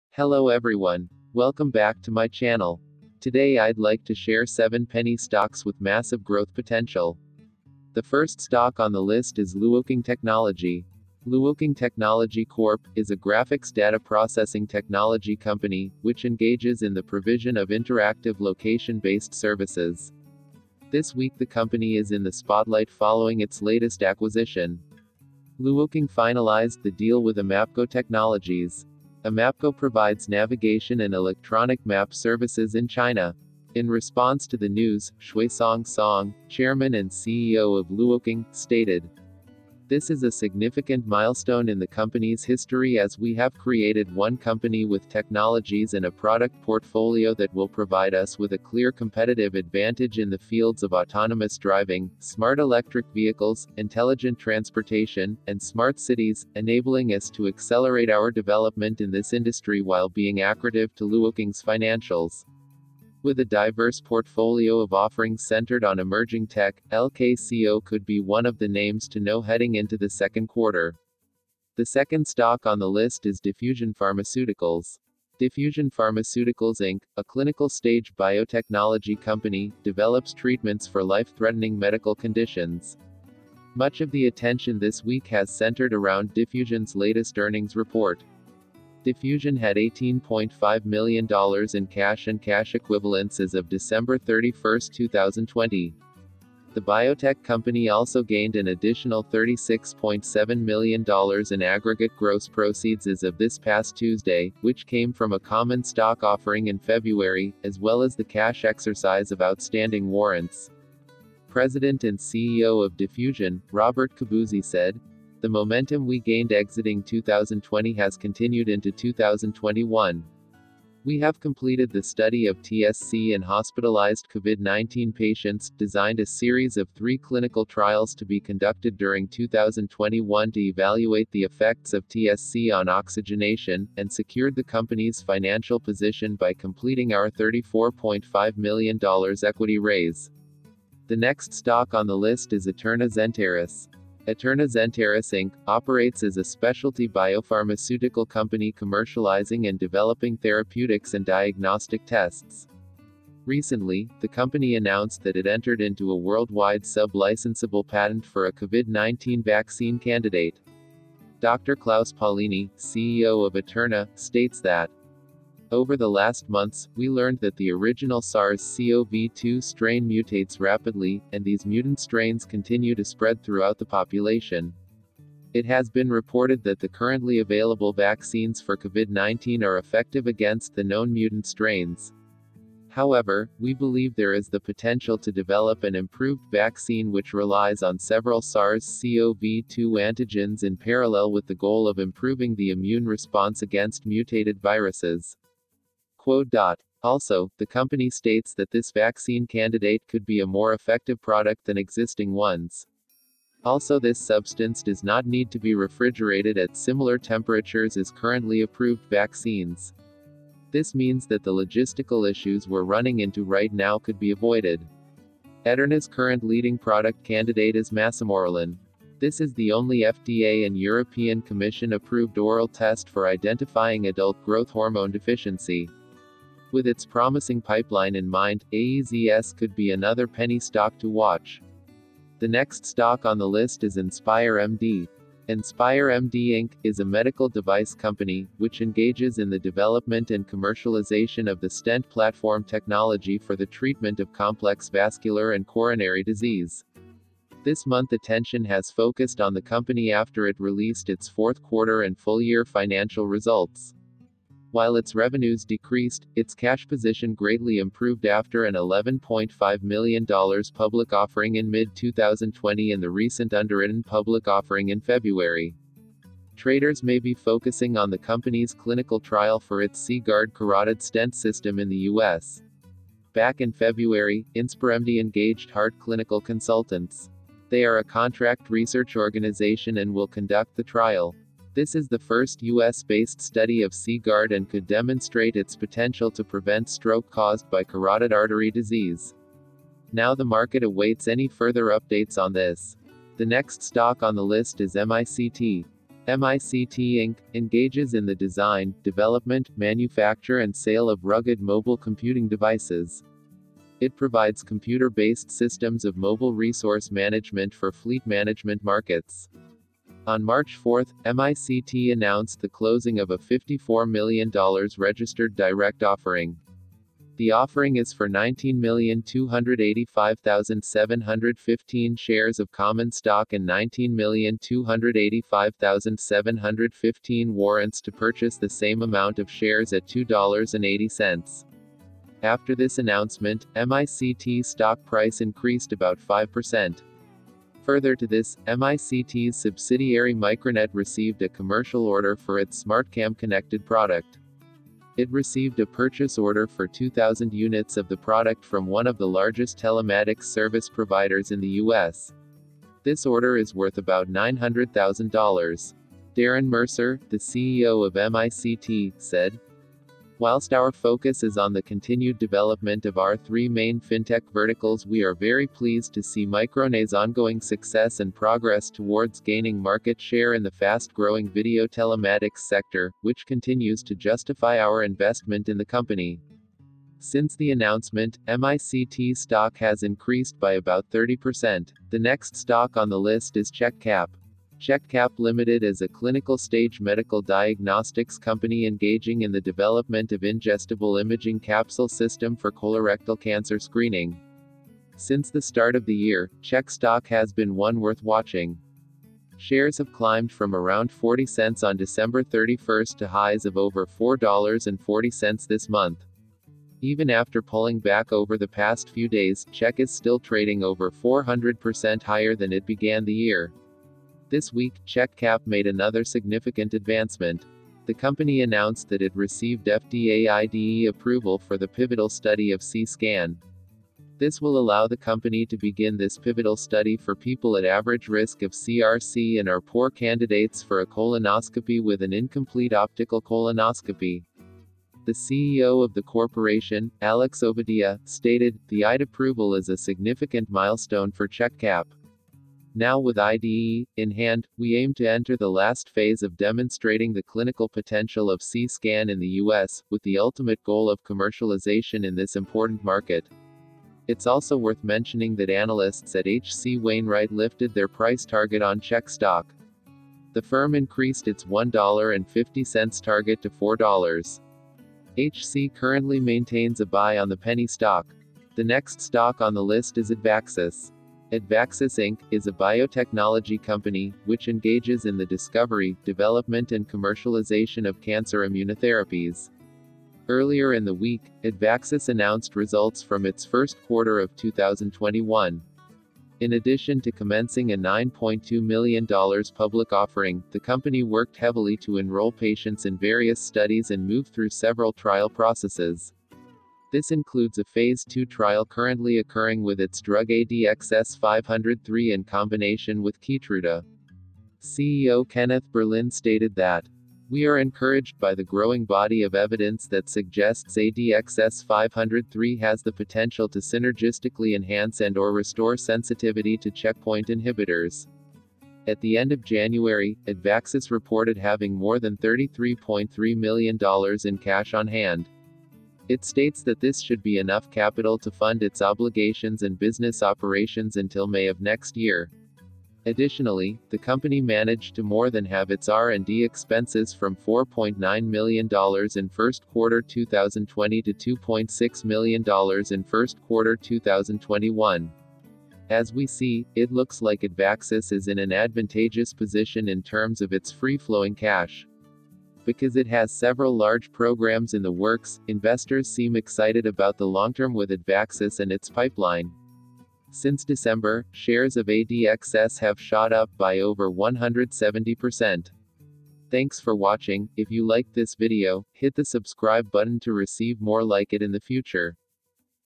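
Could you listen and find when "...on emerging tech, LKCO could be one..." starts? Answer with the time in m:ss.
1:05.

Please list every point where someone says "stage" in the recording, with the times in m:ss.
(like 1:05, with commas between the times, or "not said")
1:17, 6:26.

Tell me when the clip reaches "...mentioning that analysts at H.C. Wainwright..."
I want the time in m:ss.
7:35.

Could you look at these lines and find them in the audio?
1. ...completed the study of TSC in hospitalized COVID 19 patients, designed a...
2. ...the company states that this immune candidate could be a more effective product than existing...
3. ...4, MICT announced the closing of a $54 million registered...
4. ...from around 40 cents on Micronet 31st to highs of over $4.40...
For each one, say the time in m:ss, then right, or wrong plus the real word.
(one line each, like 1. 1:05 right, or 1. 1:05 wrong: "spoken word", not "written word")
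1. 2:01 right
2. 3:17 wrong: "vaccine", not "immune"
3. 5:10 right
4. 6:40 wrong: "December", not "Micronet".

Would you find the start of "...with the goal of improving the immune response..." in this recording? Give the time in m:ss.
3:11.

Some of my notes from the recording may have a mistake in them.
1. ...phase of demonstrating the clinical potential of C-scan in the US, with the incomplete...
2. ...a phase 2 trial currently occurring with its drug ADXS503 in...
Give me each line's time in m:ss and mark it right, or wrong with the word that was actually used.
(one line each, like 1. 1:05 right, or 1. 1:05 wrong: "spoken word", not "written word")
1. 7:26 wrong: "ultimate", not "incomplete"
2. 8:17 right.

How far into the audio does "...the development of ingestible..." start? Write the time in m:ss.
6:29.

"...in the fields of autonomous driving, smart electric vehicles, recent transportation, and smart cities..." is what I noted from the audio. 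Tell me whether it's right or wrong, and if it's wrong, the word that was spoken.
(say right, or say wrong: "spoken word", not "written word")
wrong: "intelligent", not "recent".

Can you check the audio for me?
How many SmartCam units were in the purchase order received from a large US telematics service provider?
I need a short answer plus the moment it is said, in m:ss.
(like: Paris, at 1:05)
2,000, at 5:46.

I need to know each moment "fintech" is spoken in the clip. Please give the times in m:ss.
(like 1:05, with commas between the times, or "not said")
6:04.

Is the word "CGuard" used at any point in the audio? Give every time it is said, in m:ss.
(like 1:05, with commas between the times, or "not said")
4:30, 4:43.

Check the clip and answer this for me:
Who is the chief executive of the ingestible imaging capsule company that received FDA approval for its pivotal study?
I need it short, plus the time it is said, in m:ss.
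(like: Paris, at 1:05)
Alex Ovadia, at 7:17.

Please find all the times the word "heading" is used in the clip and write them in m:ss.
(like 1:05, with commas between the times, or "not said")
1:09.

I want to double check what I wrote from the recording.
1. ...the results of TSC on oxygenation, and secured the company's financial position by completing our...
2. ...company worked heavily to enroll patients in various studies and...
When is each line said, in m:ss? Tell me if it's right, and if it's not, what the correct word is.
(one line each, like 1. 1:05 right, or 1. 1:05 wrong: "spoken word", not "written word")
1. 2:11 wrong: "effects", not "results"
2. 8:10 right.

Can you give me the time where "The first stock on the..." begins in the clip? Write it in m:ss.
0:07.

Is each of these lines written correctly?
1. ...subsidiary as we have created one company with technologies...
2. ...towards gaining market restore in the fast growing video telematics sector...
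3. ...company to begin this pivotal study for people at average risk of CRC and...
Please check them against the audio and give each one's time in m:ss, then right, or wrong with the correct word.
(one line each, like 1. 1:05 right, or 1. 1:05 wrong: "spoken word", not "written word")
1. 0:42 wrong: "history", not "subsidiary"
2. 6:08 wrong: "share", not "restore"
3. 7:05 right.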